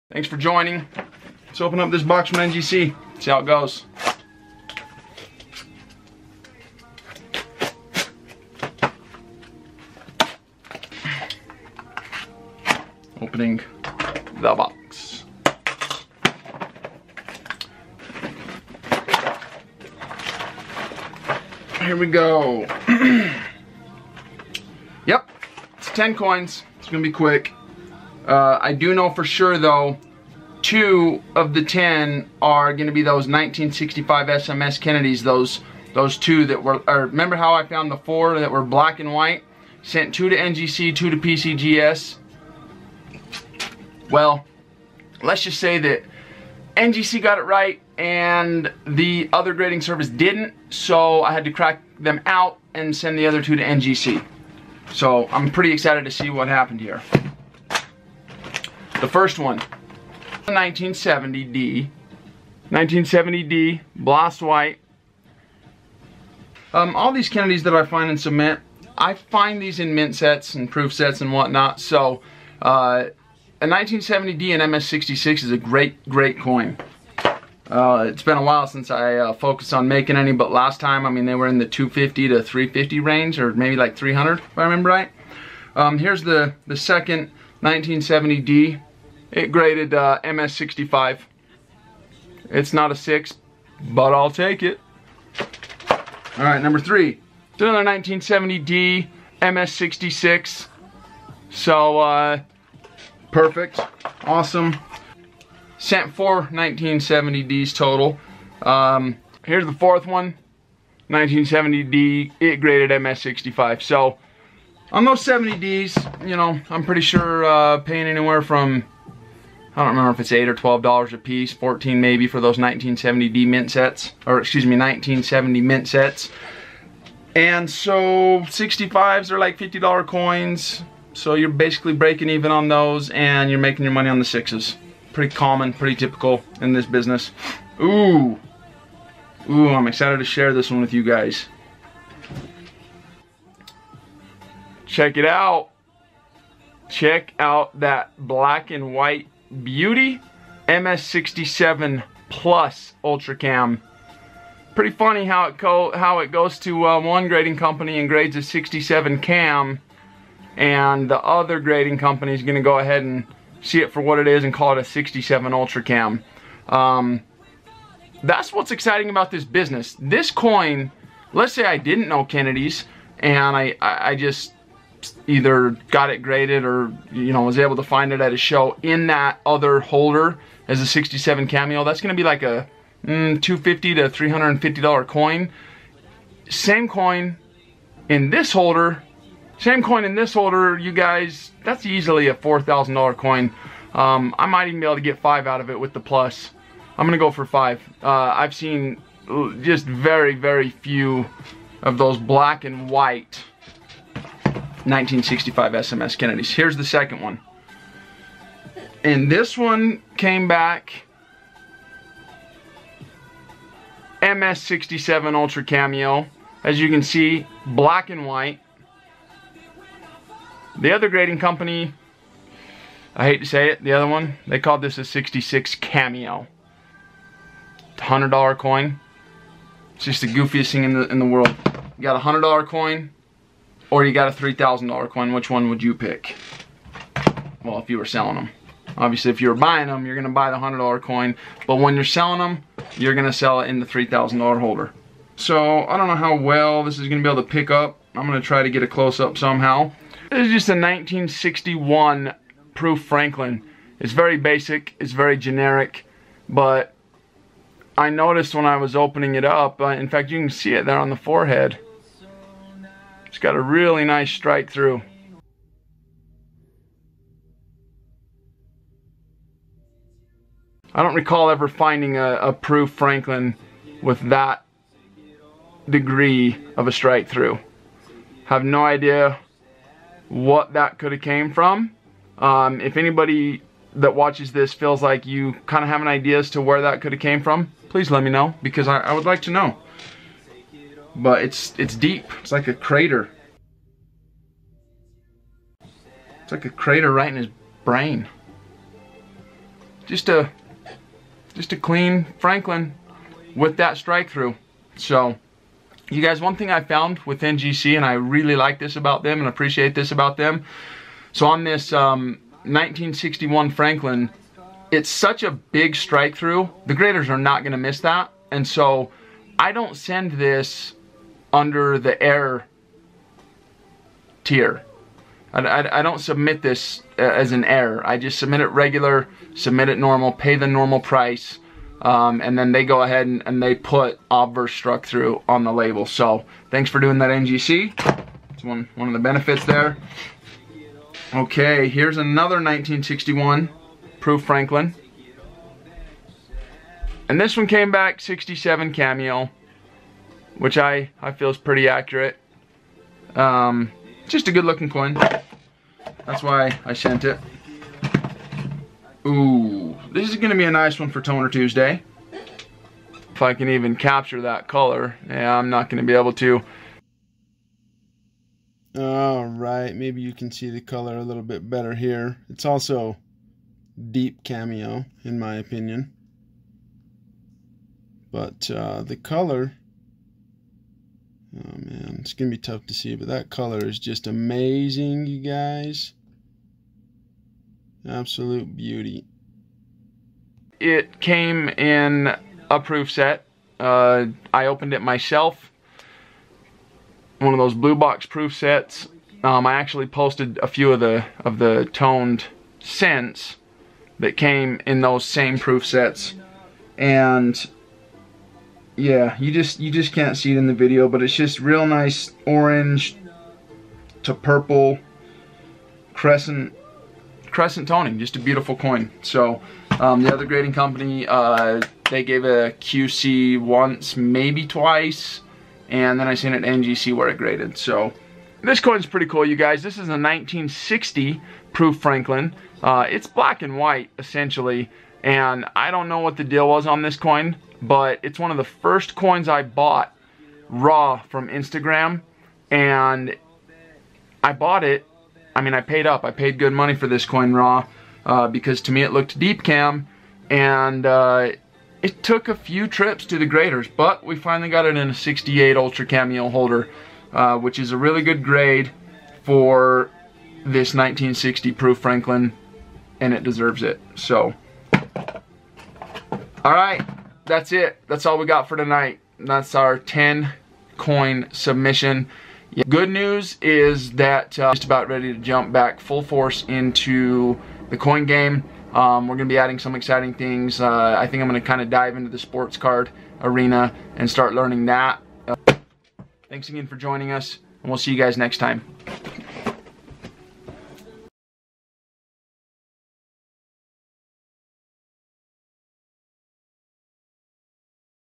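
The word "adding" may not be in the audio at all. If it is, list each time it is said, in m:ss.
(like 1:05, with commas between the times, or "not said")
7:59.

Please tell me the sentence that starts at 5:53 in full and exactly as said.
Um, just a good looking coin.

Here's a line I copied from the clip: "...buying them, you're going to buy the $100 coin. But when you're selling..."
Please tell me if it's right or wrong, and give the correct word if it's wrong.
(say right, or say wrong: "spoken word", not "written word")
right.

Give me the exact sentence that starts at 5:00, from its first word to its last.
Just a just a clean Franklin with that strike through.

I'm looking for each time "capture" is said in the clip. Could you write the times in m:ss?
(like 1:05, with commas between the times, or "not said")
6:03.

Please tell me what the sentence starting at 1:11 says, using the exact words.
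So uh, a 1970D and MS66 is a great, great coin.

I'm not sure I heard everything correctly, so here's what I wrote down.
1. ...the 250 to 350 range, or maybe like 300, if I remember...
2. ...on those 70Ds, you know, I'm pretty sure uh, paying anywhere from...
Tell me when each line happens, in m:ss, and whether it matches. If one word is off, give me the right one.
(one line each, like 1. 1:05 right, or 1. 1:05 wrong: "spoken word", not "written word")
1. 1:21 right
2. 1:54 right.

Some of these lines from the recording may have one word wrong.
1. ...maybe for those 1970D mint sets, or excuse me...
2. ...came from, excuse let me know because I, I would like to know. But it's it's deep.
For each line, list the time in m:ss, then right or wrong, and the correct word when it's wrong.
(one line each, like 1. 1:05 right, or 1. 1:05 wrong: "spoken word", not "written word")
1. 2:02 right
2. 4:47 wrong: "please", not "excuse".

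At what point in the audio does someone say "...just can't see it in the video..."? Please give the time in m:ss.
6:49.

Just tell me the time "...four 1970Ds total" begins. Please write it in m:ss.
1:46.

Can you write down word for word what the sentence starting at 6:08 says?
All right, maybe you can see the color a little bit better here.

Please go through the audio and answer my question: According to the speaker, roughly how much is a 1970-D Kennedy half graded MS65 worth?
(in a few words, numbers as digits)
$50.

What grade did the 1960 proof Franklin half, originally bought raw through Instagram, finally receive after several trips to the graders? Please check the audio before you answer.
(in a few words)
68 Ultra Cameo.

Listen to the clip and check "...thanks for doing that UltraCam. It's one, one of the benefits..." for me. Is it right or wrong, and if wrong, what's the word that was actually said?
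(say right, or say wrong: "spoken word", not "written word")
wrong: "NGC", not "UltraCam".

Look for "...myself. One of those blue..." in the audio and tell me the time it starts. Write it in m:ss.
6:35.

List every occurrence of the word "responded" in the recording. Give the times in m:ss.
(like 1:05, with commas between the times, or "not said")
not said.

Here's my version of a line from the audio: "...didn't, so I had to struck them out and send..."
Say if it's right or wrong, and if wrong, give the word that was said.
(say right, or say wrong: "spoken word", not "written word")
wrong: "crack", not "struck".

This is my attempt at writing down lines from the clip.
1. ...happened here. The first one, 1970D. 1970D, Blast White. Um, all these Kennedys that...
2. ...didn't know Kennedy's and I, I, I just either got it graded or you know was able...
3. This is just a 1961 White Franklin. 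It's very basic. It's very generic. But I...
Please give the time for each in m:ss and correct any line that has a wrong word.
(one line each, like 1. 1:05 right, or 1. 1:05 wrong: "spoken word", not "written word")
1. 0:56 right
2. 2:51 right
3. 4:10 wrong: "Proof", not "White".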